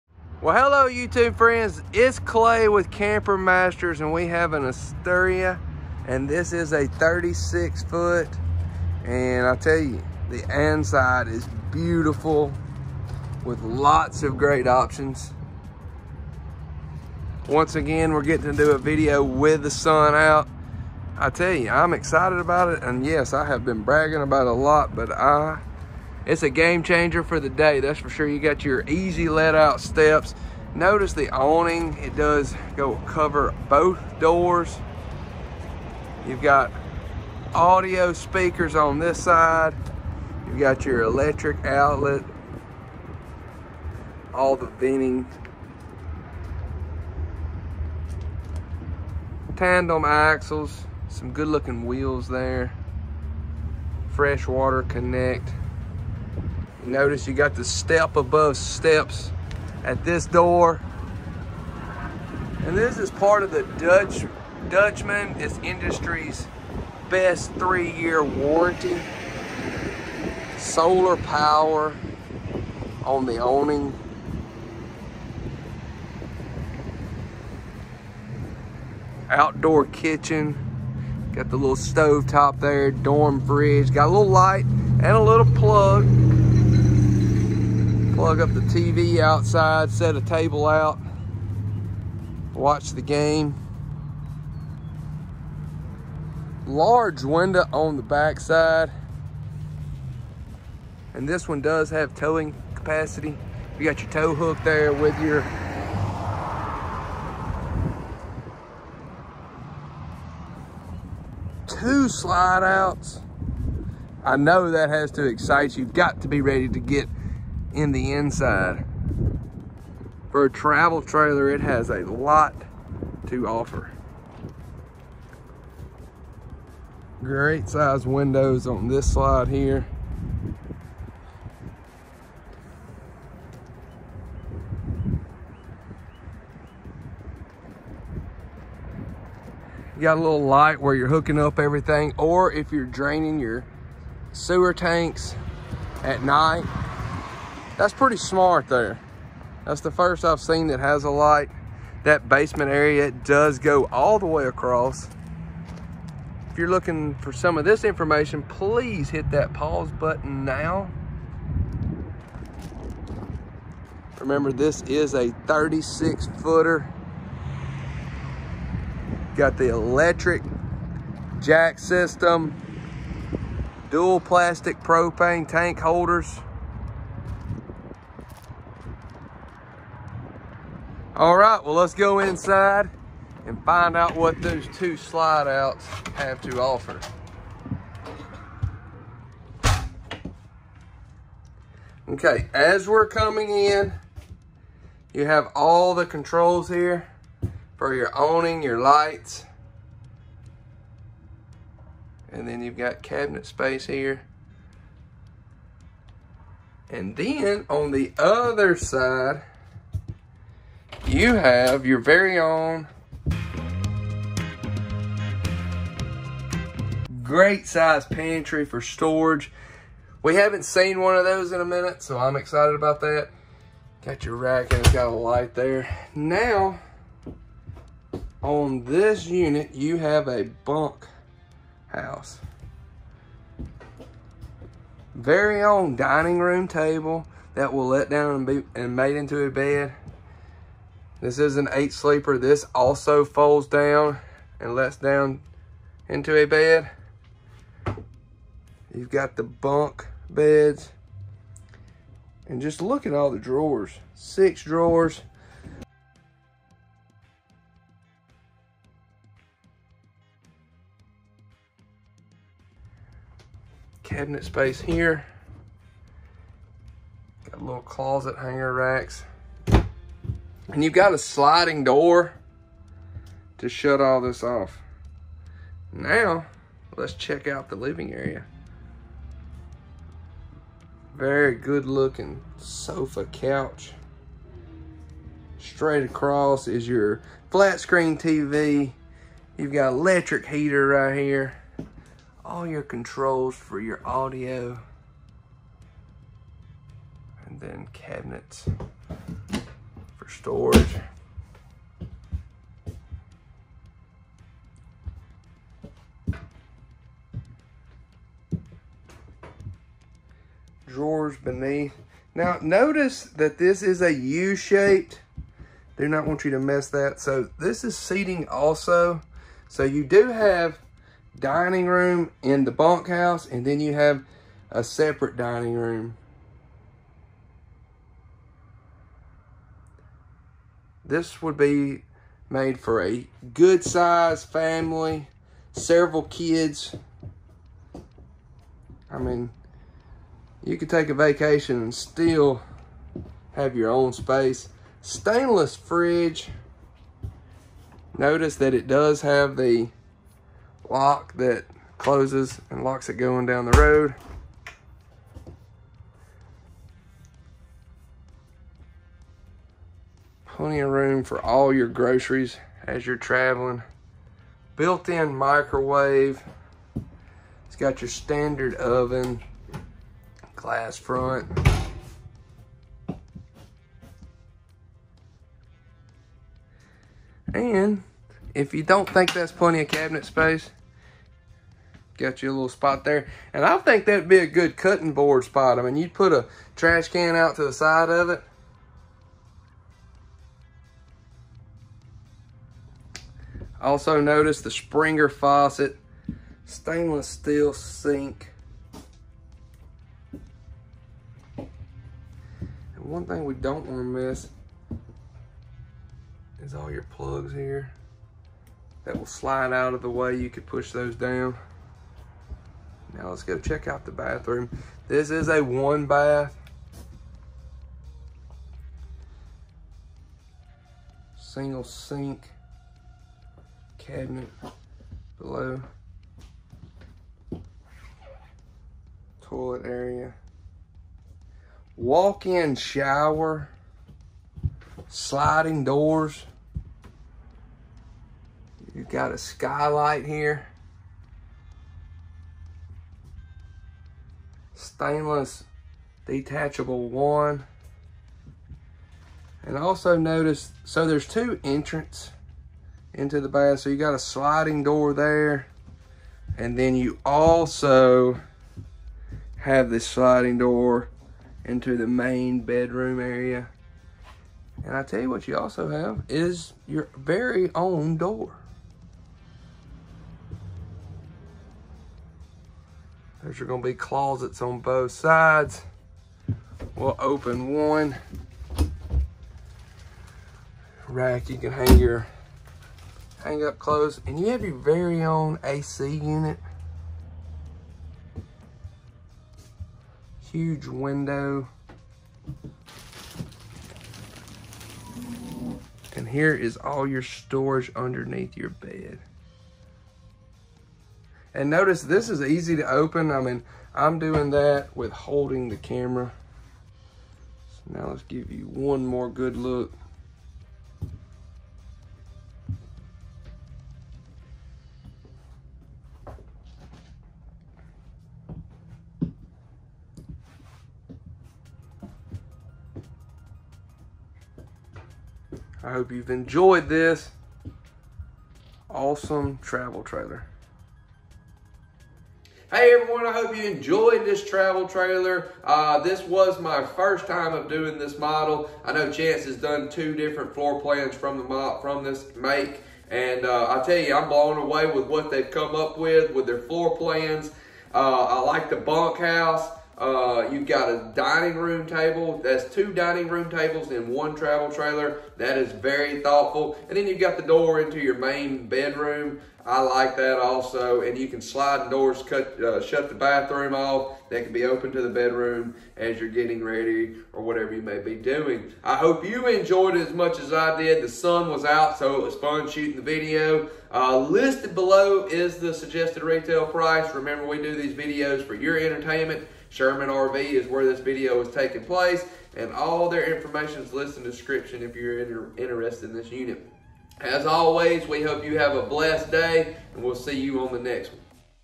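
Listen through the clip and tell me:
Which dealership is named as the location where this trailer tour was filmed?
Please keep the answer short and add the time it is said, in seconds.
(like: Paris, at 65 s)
Sherman RV, at 579 s.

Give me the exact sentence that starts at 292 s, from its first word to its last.
All your controls for your audio.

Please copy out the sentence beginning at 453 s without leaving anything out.
So you got a sliding door there.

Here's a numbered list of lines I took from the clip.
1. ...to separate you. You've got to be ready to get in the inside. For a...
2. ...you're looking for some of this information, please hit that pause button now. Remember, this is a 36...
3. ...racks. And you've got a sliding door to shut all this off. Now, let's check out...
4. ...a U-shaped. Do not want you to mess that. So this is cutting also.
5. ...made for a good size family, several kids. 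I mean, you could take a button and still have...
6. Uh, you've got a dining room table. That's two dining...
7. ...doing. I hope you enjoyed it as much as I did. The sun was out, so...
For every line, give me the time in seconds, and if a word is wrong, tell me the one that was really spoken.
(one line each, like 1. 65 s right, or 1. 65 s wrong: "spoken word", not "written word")
1. 115 s wrong: "excite", not "separate"
2. 156 s right
3. 268 s right
4. 314 s wrong: "seating", not "cutting"
5. 332 s wrong: "vacation", not "button"
6. 550 s right
7. 568 s right.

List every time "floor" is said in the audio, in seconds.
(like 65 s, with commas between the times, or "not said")
540 s, 546 s.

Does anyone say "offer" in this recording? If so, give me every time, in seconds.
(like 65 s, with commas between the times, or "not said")
123 s, 186 s.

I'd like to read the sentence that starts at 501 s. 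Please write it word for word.
And notice this is easy to open.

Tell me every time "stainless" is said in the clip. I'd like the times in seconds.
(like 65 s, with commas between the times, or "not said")
345 s, 396 s, 444 s.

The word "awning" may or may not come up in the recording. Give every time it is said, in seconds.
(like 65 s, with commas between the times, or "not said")
31 s, 73 s, 198 s.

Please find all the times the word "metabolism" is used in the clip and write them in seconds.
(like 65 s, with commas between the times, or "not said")
not said.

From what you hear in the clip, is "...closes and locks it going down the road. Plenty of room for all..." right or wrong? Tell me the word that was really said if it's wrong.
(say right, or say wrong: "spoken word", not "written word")
right.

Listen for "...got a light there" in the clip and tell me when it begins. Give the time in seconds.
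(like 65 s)
224 s.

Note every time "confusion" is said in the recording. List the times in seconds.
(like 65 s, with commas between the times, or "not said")
not said.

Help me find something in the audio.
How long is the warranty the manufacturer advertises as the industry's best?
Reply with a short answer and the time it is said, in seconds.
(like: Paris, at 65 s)
three-year, at 67 s.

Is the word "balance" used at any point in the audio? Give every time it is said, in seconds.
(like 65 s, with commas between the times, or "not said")
not said.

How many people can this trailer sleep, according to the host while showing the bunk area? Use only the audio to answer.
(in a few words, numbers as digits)
8.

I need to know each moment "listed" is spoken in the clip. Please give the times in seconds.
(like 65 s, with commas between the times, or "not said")
574 s, 583 s.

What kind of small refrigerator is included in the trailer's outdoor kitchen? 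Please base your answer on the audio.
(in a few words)
dorm fridge.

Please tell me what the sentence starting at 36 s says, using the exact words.
You've got audio speakers on this side.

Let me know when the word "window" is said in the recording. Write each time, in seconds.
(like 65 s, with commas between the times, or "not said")
97 s, 128 s, 490 s.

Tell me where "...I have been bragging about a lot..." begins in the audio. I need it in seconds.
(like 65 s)
23 s.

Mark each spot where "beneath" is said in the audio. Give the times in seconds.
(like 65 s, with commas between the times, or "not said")
311 s.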